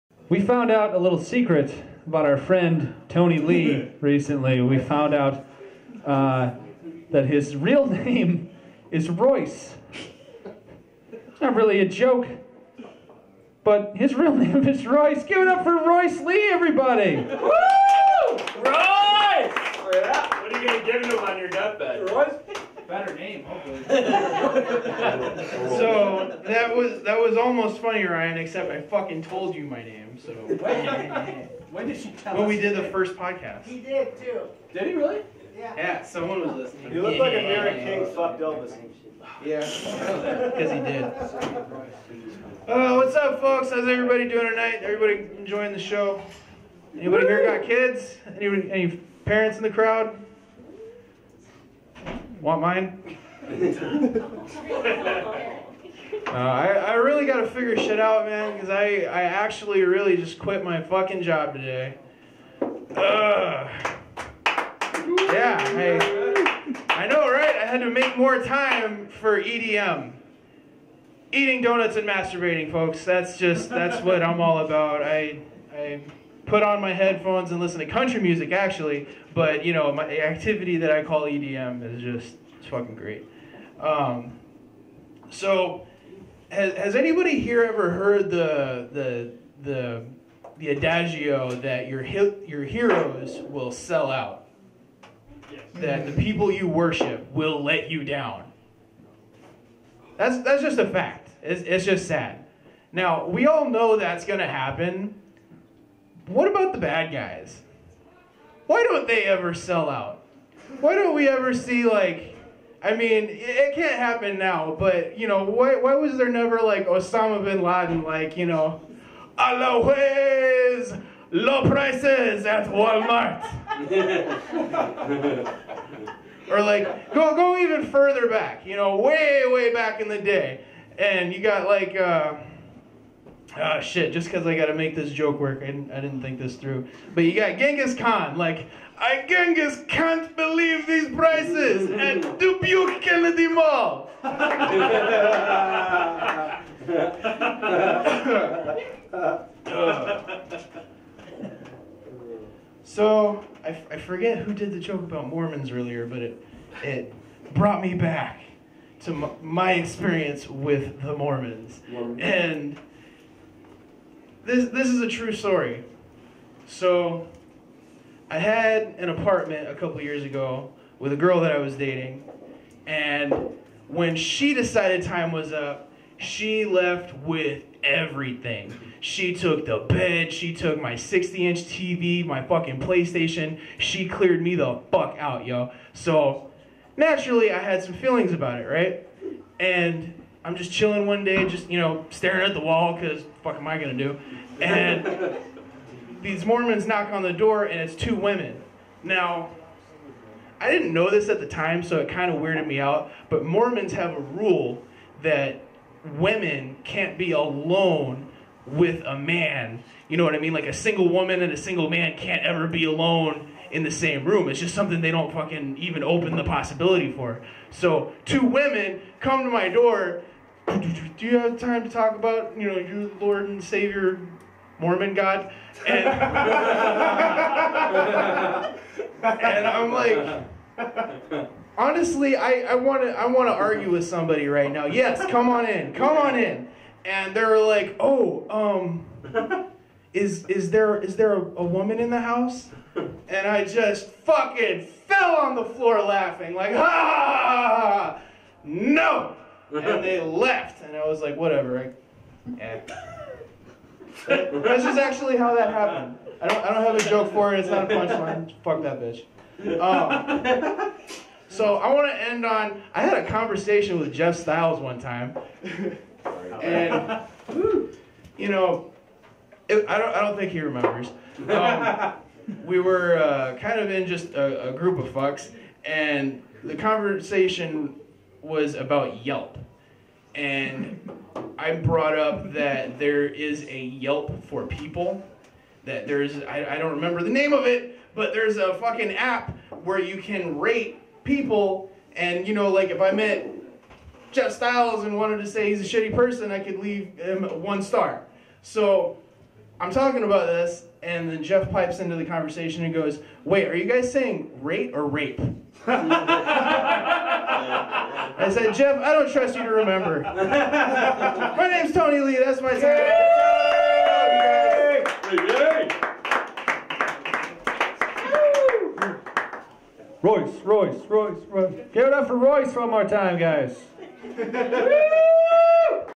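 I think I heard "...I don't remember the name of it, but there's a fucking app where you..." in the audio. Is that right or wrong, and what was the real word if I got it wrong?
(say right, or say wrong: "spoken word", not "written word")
right.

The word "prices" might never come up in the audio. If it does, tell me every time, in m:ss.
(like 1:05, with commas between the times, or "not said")
2:01, 2:21.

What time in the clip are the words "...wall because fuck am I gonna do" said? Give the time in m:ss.
3:12.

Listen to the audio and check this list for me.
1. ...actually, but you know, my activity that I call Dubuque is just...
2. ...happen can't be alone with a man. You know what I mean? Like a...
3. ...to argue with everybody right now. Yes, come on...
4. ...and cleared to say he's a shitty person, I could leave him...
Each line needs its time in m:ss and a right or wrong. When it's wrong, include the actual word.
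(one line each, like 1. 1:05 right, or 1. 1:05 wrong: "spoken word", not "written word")
1. 1:18 wrong: "EDM", not "Dubuque"
2. 3:26 wrong: "women", not "happen"
3. 3:53 wrong: "somebody", not "everybody"
4. 4:55 wrong: "wanted", not "cleared".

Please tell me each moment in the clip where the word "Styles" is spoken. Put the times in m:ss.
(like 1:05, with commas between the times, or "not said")
4:24, 4:54.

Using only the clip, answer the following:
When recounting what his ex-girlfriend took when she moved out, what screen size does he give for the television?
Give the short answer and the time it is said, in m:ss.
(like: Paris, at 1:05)
60 inch, at 3:00.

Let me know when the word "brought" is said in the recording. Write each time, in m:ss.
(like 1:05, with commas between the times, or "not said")
2:37, 4:41.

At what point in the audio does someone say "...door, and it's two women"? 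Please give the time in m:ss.
3:17.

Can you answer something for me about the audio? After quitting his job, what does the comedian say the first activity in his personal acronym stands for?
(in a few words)
Eating donuts.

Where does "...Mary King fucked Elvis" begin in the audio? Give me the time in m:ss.
0:37.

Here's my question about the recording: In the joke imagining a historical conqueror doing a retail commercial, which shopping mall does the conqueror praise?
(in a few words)
Dubuque Kennedy Mall.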